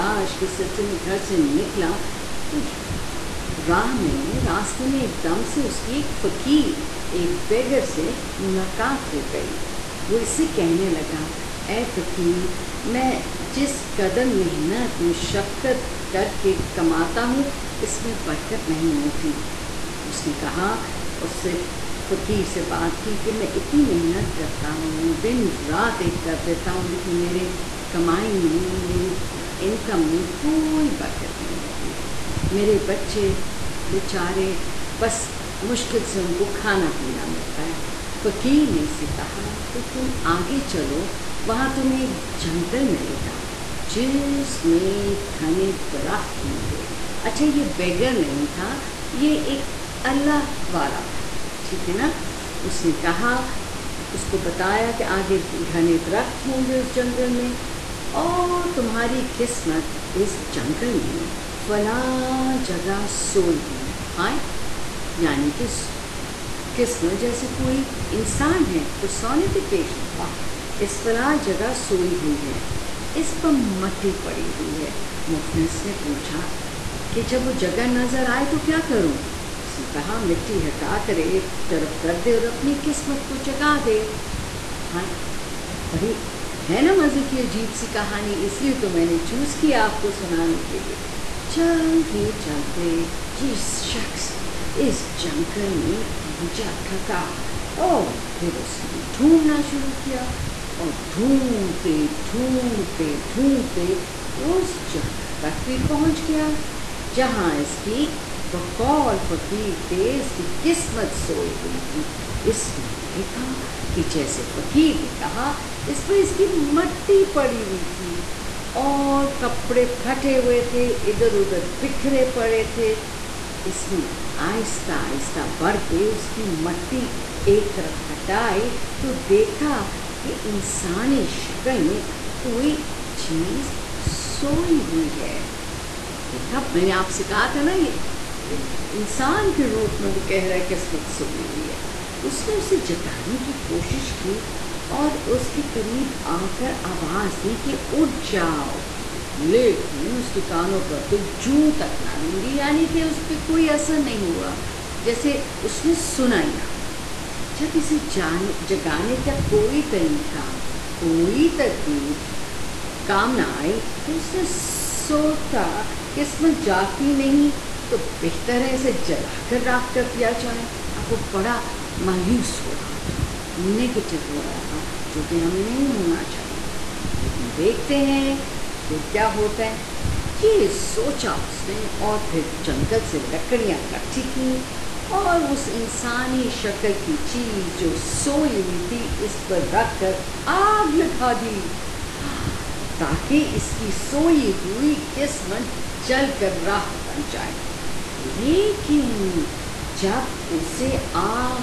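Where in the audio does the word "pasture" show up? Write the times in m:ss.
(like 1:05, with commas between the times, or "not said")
not said.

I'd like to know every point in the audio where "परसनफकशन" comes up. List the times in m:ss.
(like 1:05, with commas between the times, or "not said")
1:08.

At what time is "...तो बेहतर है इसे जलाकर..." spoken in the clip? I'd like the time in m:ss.
2:47.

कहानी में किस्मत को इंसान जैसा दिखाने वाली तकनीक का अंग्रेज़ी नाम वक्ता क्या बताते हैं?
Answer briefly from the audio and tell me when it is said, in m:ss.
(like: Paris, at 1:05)
पर्सोनिफिकेशन, at 1:08.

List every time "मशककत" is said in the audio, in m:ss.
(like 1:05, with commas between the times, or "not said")
0:15.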